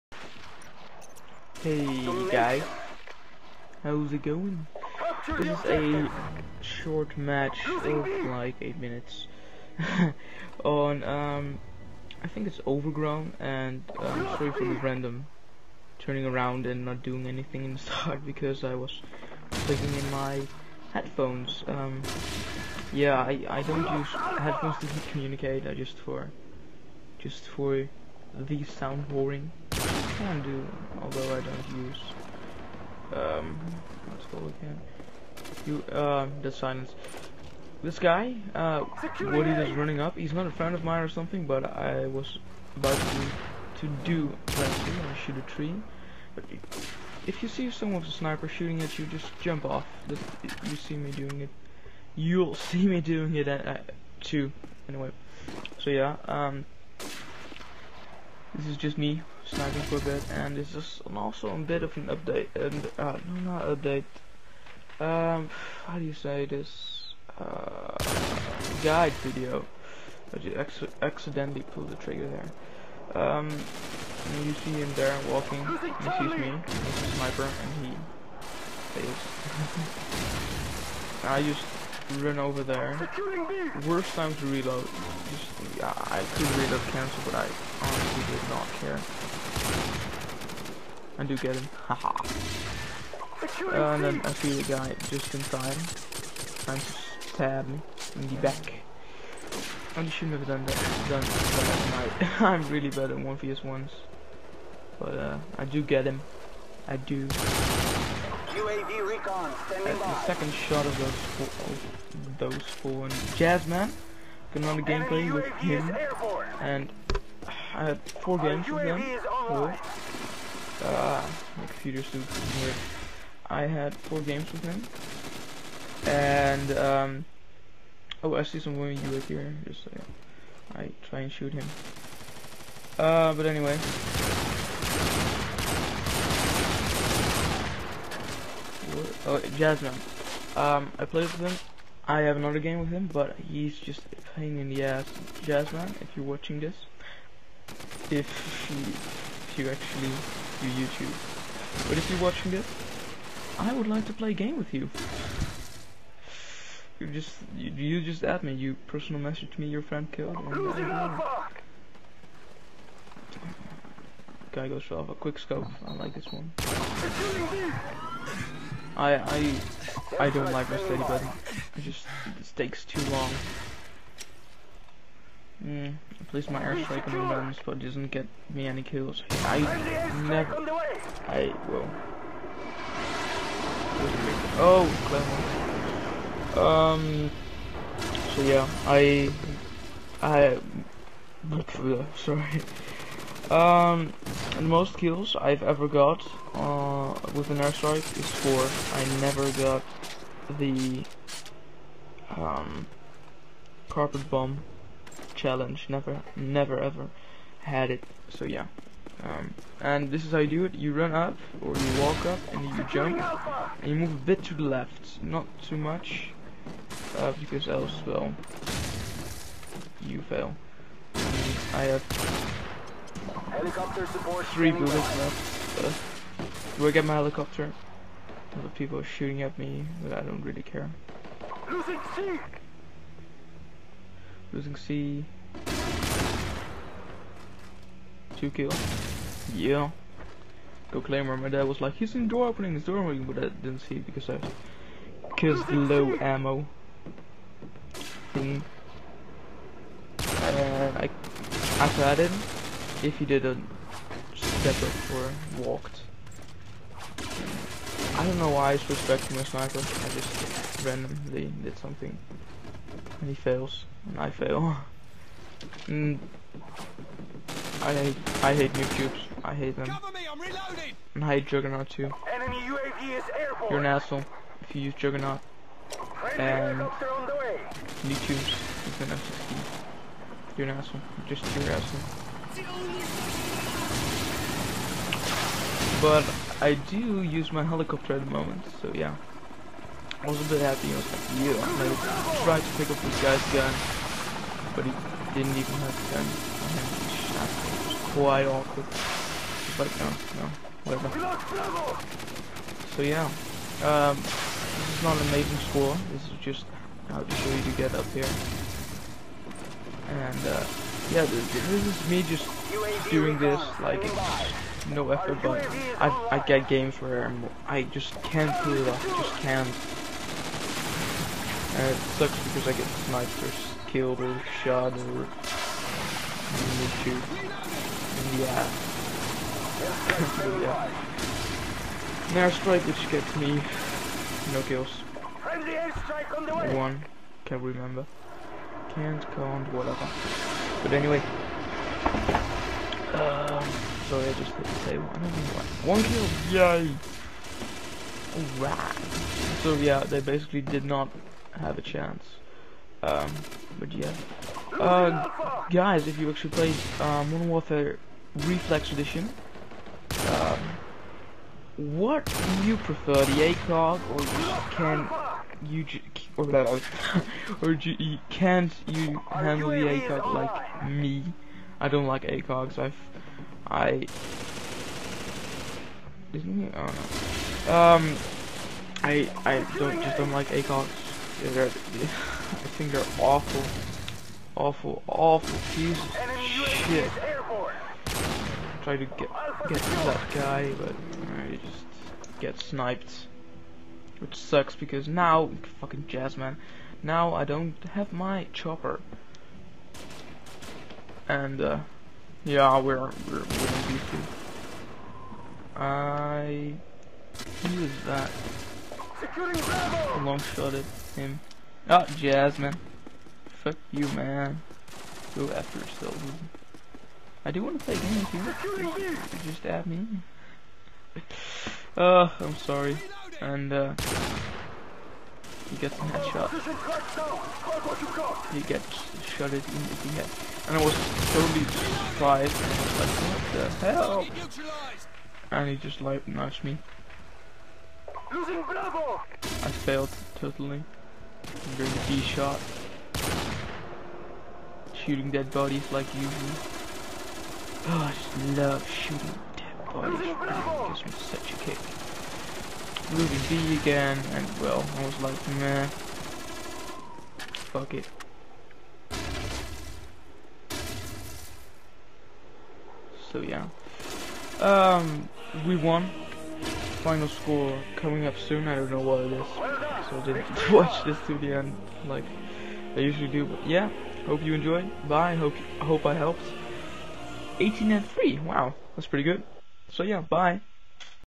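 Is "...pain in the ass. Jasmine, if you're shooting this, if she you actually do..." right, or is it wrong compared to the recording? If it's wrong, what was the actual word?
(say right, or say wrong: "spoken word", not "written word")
wrong: "watching", not "shooting".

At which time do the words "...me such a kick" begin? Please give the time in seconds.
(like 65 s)
451 s.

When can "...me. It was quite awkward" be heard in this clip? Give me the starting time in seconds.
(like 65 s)
297 s.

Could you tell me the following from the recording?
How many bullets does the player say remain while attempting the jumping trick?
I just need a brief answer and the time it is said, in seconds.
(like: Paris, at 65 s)
3, at 224 s.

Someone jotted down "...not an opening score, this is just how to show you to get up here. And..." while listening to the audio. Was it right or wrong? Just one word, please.
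wrong.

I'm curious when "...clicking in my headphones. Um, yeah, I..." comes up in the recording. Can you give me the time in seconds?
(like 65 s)
19 s.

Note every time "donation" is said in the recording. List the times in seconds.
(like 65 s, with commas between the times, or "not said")
not said.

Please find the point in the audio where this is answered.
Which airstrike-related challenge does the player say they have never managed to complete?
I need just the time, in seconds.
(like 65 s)
203 s.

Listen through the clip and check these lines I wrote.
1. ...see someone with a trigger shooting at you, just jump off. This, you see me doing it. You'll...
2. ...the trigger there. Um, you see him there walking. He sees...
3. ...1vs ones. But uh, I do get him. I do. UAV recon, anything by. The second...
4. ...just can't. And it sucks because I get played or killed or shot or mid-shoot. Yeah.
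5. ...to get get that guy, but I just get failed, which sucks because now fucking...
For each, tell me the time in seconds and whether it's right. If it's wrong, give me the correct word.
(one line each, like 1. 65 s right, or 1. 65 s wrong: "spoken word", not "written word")
1. 47 s wrong: "sniper", not "trigger"
2. 71 s right
3. 103 s wrong: "standing", not "anything"
4. 319 s wrong: "sniped", not "played"
5. 388 s wrong: "sniped", not "failed".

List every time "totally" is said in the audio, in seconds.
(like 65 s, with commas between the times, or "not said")
431 s, 440 s.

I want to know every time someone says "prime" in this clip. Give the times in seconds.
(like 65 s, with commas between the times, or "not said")
not said.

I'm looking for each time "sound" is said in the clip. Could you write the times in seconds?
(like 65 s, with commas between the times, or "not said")
28 s.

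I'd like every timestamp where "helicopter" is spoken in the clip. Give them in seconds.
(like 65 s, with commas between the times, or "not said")
227 s, 287 s.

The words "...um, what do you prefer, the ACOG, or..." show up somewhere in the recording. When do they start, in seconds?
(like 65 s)
360 s.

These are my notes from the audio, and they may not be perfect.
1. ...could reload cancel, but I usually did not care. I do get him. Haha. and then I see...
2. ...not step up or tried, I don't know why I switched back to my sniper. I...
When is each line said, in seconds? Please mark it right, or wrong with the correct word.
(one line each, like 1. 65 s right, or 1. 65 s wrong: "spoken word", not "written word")
1. 86 s wrong: "honestly", not "usually"
2. 253 s wrong: "walked", not "tried".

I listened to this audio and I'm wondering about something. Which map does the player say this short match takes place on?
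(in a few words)
Overgrown.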